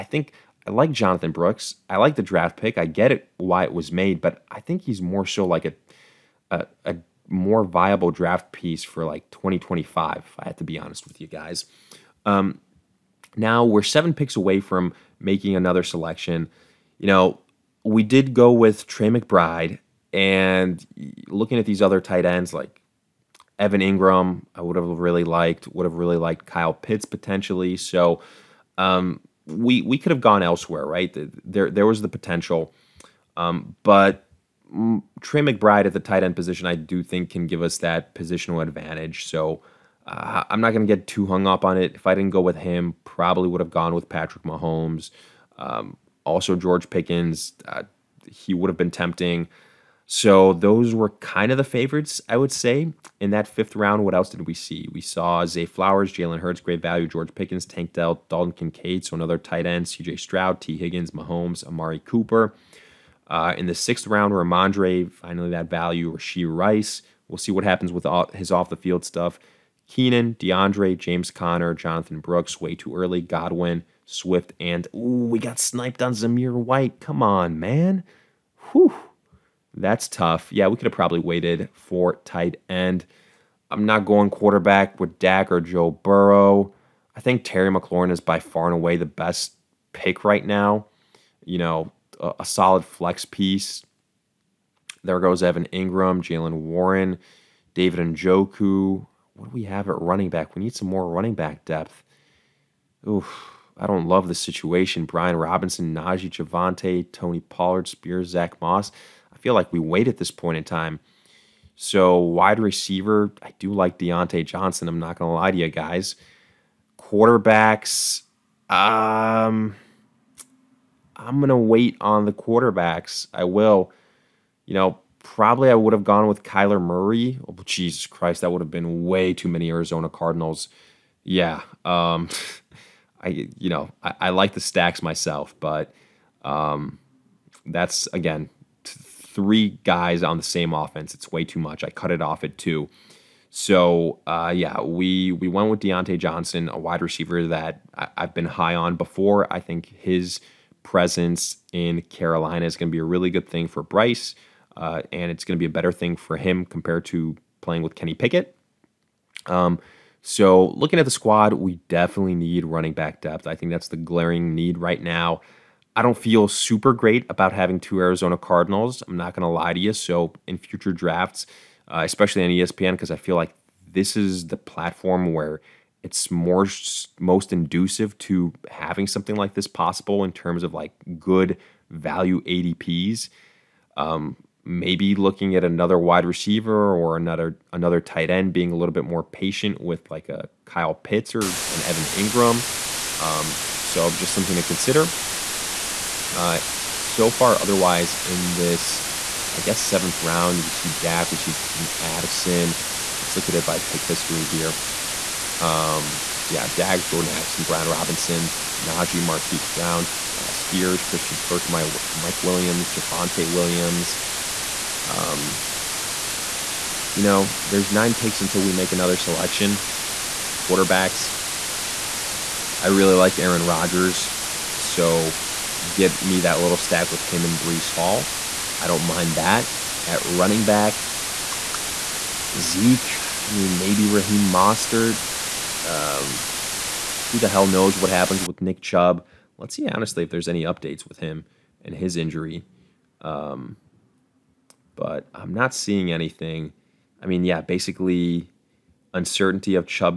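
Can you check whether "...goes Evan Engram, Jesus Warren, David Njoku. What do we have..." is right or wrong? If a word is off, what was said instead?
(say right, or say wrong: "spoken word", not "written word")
wrong: "Jaylen", not "Jesus".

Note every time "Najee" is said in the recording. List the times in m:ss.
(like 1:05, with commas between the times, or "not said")
1:45, 3:28.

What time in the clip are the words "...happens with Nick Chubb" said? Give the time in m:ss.
3:58.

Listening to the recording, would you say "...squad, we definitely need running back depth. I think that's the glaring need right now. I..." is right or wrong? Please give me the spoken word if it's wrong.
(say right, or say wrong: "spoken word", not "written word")
right.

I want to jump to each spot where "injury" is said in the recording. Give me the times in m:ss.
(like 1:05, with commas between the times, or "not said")
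4:02.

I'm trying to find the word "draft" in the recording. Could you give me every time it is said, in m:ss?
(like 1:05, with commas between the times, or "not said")
0:02, 0:08, 2:50.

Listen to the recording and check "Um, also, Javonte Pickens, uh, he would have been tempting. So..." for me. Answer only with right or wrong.
wrong.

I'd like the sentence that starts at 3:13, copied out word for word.
Um, so just something to consider.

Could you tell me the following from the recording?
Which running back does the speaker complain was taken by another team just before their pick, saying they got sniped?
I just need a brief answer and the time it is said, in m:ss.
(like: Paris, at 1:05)
Zamir White, at 1:16.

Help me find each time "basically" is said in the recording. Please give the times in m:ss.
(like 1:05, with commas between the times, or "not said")
4:07.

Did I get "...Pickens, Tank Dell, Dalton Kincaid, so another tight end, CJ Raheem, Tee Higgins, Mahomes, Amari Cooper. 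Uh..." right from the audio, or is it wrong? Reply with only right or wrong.
wrong.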